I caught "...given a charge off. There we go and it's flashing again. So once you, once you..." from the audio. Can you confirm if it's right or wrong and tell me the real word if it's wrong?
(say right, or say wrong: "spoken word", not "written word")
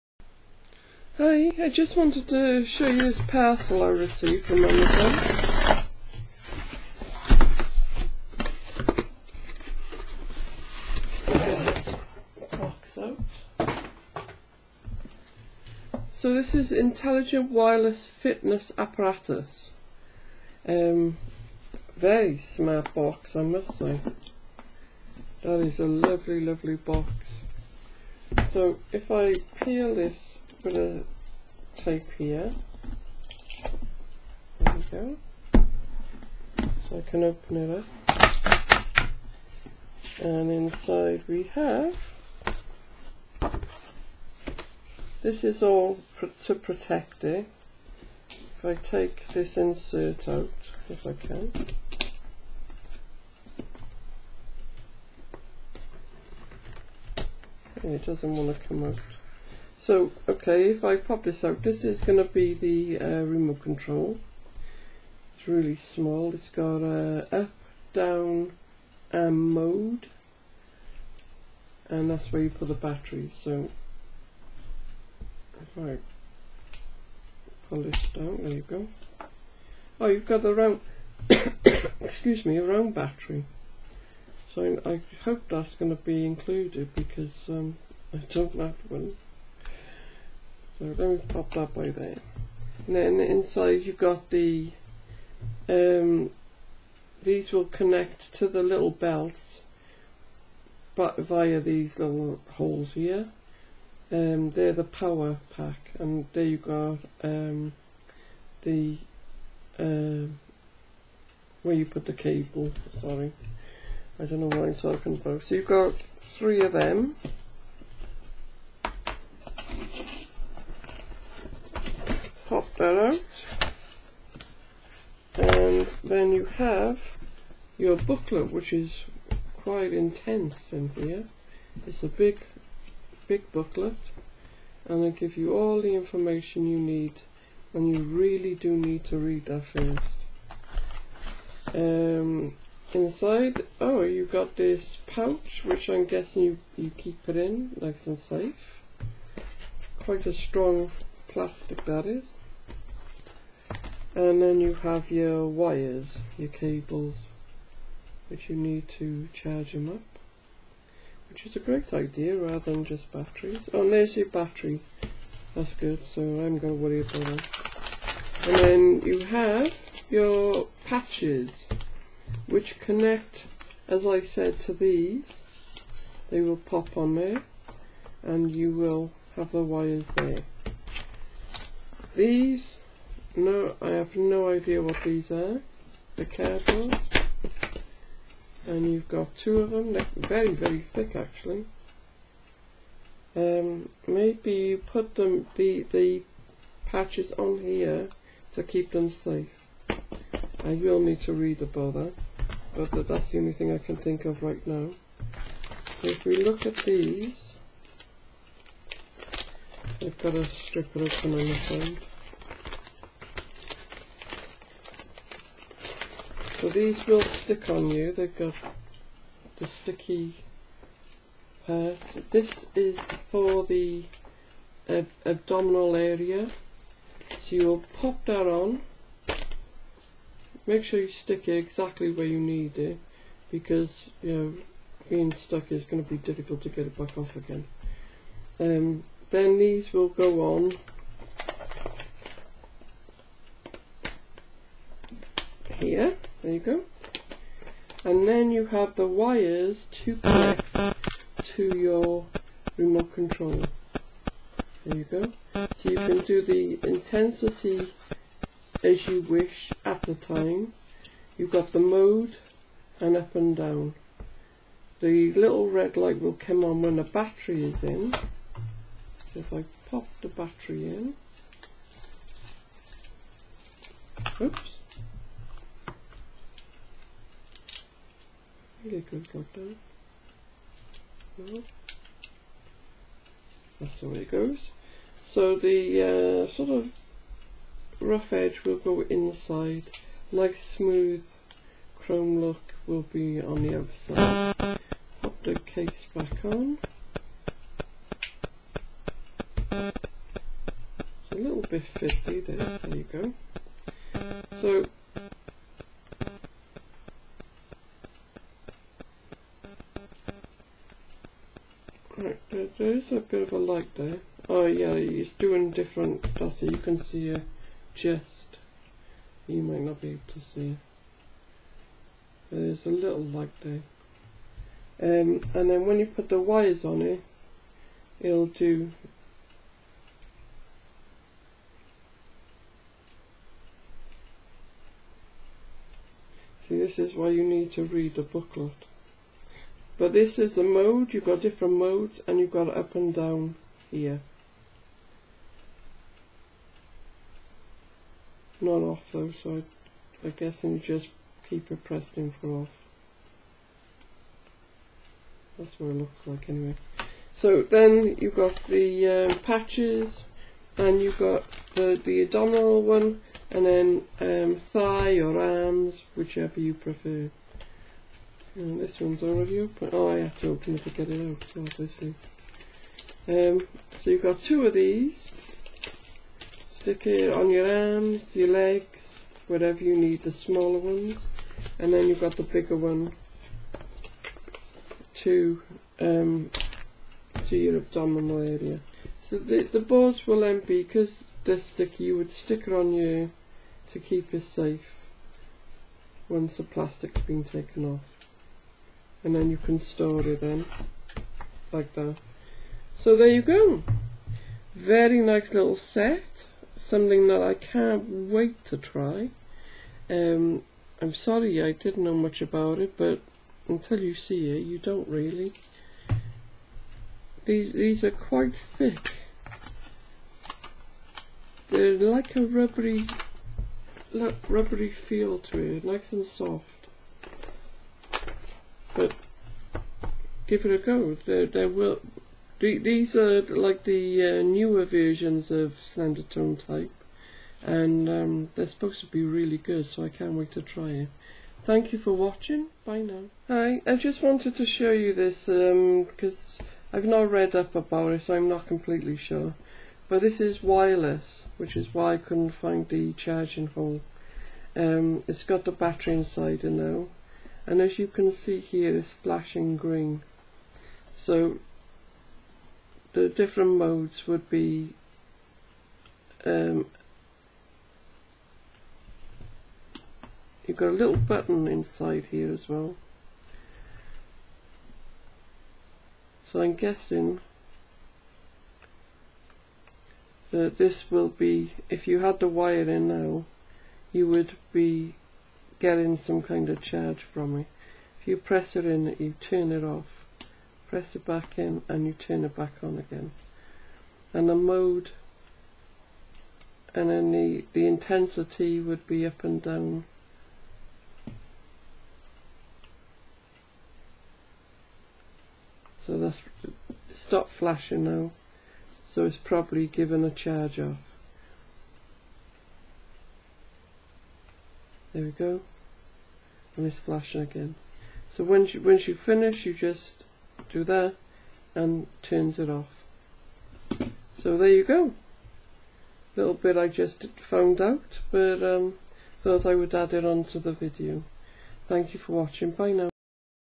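right.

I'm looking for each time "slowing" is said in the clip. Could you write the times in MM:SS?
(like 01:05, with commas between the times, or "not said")
not said.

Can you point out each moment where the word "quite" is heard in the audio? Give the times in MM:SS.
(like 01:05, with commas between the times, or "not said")
02:09, 02:29, 06:58.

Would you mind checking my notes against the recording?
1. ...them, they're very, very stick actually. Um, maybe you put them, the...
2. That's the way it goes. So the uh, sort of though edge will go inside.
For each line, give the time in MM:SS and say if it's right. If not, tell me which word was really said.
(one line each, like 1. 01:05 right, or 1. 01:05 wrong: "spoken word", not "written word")
1. 03:09 wrong: "thick", not "stick"
2. 04:43 wrong: "rough", not "though".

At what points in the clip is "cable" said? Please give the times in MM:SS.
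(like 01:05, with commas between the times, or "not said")
01:52, 02:36.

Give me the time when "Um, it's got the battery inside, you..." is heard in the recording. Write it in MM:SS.
07:34.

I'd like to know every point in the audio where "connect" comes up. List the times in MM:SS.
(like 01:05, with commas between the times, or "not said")
01:37, 02:52, 04:10.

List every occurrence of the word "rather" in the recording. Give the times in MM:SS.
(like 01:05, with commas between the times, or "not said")
02:42.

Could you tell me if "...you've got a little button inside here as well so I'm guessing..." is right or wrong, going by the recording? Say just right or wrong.
right.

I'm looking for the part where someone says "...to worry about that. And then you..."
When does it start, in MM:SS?
02:46.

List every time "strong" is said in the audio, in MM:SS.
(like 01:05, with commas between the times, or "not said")
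02:30.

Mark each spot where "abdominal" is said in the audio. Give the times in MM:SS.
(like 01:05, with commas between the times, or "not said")
03:45, 06:02, 06:27.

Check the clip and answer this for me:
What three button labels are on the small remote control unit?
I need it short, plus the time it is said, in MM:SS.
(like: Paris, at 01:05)
up, down, and mode, at 01:06.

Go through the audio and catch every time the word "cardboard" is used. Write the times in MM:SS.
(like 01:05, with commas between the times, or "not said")
03:06.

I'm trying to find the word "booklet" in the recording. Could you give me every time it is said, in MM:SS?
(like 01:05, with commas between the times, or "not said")
02:07, 02:13, 05:38.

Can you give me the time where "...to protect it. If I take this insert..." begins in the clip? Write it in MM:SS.
00:46.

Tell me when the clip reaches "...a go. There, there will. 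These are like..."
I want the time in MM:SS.
07:10.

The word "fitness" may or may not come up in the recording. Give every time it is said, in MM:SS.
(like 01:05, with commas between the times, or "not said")
00:18.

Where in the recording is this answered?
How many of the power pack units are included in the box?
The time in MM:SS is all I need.
01:56.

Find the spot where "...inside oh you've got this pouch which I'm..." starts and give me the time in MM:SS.
02:22.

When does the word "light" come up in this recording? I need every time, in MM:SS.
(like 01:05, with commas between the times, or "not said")
04:25, 05:13, 05:23.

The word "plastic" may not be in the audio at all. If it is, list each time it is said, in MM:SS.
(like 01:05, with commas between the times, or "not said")
02:31, 06:36.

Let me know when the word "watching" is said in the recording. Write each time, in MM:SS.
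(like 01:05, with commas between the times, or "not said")
07:22, 08:52.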